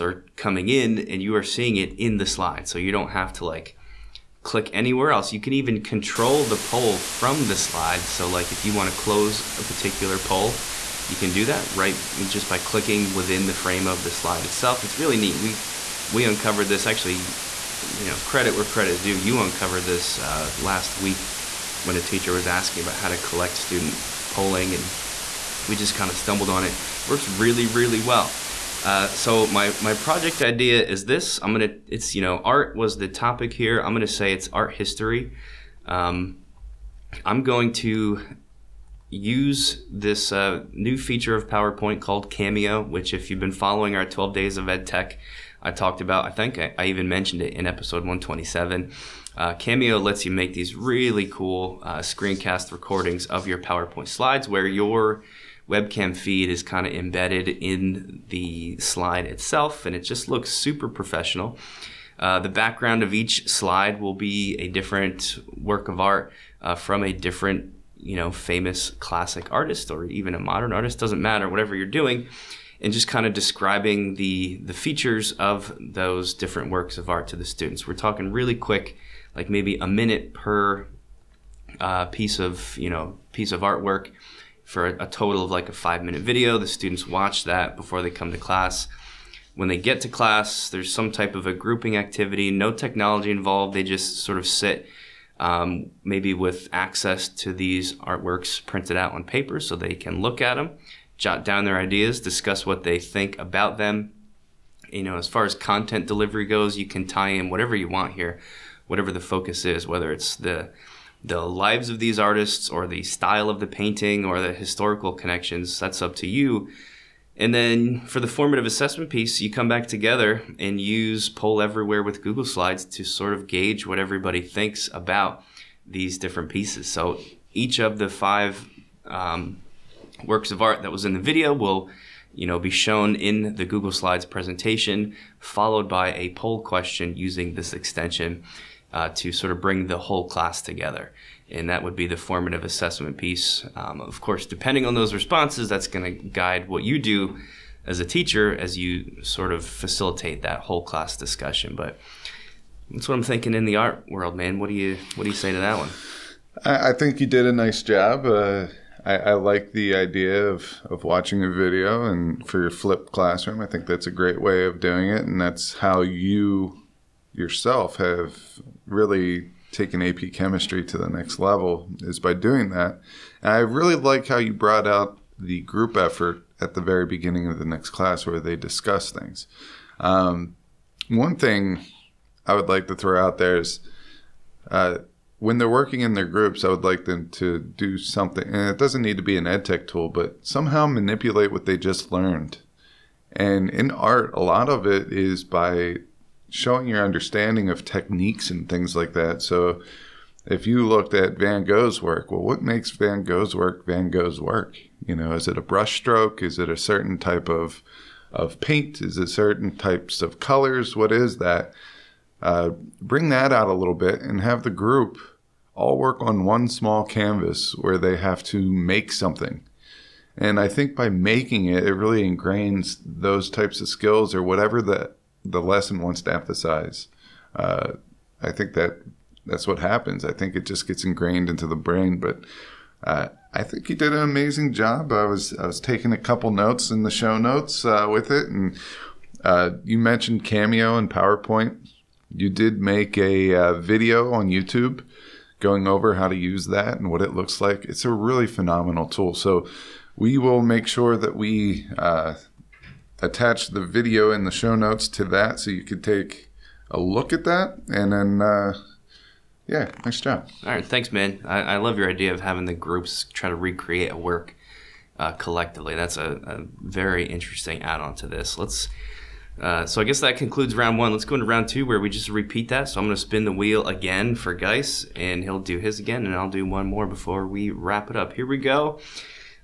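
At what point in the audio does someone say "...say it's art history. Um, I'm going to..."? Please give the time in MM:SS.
00:34.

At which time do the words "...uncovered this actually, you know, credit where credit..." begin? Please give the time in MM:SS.
00:16.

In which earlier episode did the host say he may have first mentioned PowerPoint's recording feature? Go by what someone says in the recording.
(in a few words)
127.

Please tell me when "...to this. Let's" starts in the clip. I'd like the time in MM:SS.
04:28.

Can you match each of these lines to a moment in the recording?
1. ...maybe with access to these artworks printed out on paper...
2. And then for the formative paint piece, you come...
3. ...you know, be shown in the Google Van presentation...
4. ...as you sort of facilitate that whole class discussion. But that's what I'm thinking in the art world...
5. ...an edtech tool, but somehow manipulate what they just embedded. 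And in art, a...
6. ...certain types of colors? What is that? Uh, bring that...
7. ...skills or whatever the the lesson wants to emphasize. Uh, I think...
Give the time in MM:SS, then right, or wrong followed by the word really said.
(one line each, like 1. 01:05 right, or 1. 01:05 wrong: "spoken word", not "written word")
1. 01:36 right
2. 01:57 wrong: "assessment", not "paint"
3. 02:12 wrong: "Slides", not "Van"
4. 02:28 right
5. 03:09 wrong: "learned", not "embedded"
6. 03:29 right
7. 03:43 right.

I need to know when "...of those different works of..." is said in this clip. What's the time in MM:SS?
01:15.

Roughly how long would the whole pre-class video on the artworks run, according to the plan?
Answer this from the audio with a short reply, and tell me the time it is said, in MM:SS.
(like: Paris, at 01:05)
5 minutes, at 01:25.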